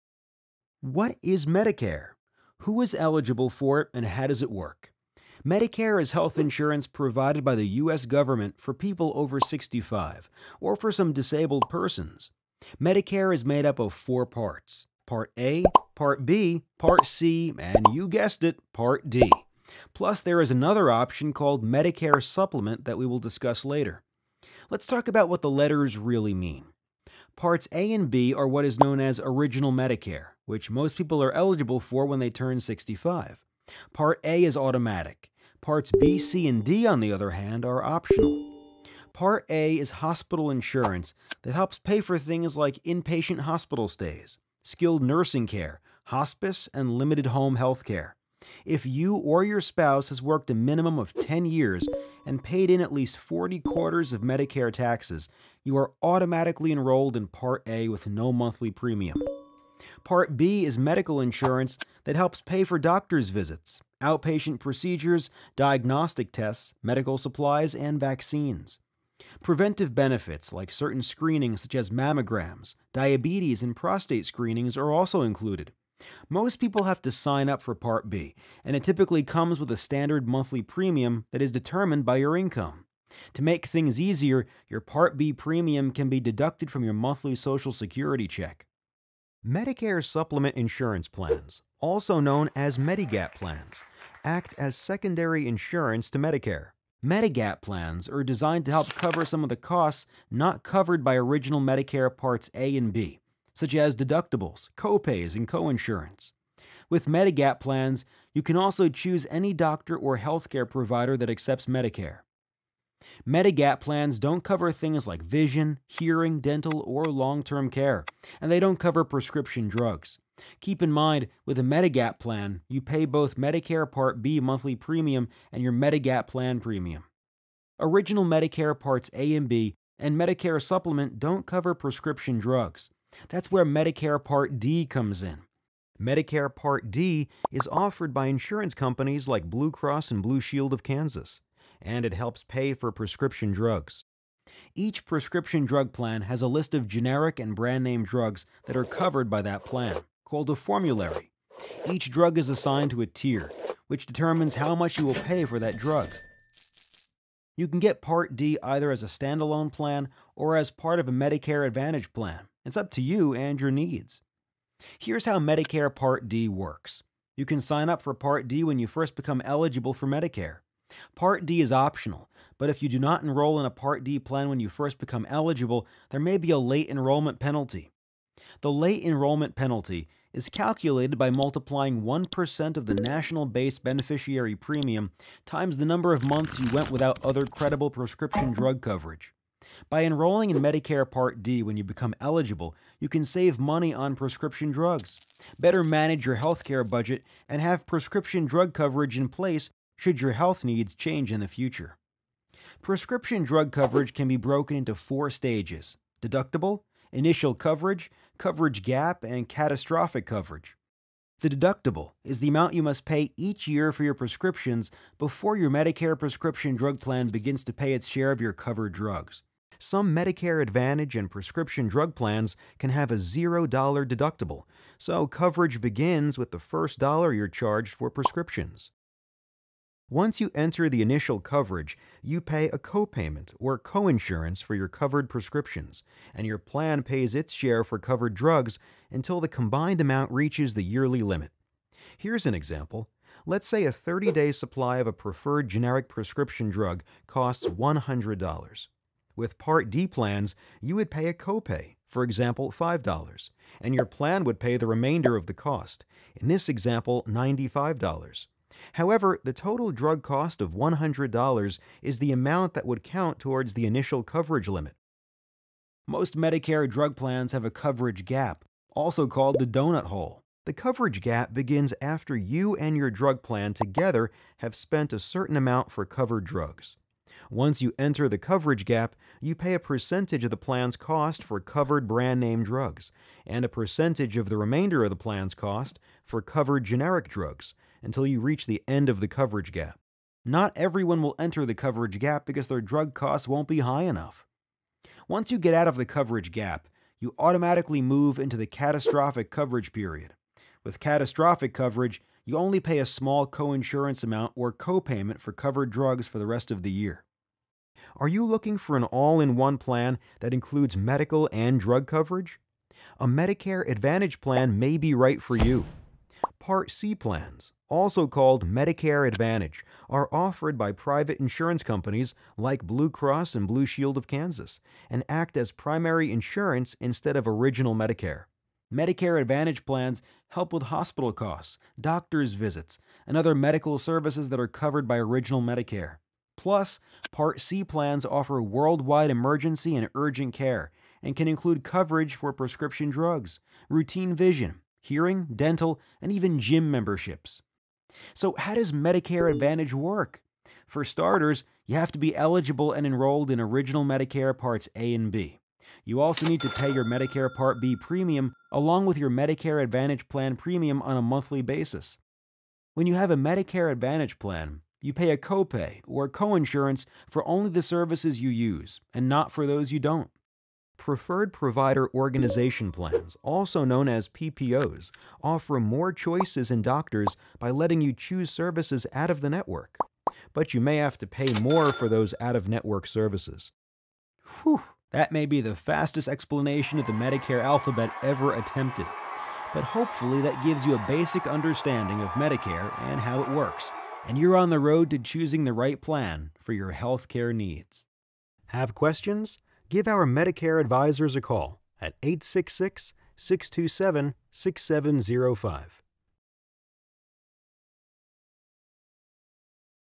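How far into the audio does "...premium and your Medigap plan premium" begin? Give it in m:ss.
2:04.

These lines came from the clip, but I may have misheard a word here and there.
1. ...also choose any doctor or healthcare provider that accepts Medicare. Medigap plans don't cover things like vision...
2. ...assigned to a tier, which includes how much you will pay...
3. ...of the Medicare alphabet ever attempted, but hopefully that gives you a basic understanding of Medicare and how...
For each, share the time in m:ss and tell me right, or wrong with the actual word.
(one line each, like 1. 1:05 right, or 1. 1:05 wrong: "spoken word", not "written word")
1. 1:48 right
2. 2:32 wrong: "determines", not "includes"
3. 6:26 right.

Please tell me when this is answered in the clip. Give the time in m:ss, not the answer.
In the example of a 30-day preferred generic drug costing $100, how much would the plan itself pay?
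4:17.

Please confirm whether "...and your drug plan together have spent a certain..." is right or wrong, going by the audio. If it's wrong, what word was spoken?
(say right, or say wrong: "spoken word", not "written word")
right.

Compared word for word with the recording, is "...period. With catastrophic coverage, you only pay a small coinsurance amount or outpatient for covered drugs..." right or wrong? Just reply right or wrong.
wrong.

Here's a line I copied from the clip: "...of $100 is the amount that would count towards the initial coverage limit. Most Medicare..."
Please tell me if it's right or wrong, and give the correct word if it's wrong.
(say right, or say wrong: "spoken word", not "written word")
right.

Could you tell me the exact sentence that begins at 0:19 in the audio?
Plus, there is another option called Medicare Supplement that we will discuss later.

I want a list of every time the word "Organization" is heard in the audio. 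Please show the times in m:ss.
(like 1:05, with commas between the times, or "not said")
6:12.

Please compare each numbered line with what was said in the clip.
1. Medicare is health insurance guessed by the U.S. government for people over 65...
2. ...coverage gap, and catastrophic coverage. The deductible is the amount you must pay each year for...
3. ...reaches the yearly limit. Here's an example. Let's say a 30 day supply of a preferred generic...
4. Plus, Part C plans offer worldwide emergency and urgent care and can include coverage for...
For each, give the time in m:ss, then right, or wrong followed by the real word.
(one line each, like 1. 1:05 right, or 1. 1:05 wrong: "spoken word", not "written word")
1. 0:05 wrong: "provided", not "guessed"
2. 3:28 right
3. 4:00 right
4. 5:36 right.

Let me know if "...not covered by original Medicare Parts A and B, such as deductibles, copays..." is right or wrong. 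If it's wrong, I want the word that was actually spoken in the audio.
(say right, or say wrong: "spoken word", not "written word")
right.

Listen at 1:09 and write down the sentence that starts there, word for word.
Preventive benefits like certain screenings such as mammograms, diabetes, and prostate screenings are also included.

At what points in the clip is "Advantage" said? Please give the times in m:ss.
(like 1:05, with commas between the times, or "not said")
2:41, 3:40, 5:13, 5:19, 5:29, 5:49, 5:59, 6:03.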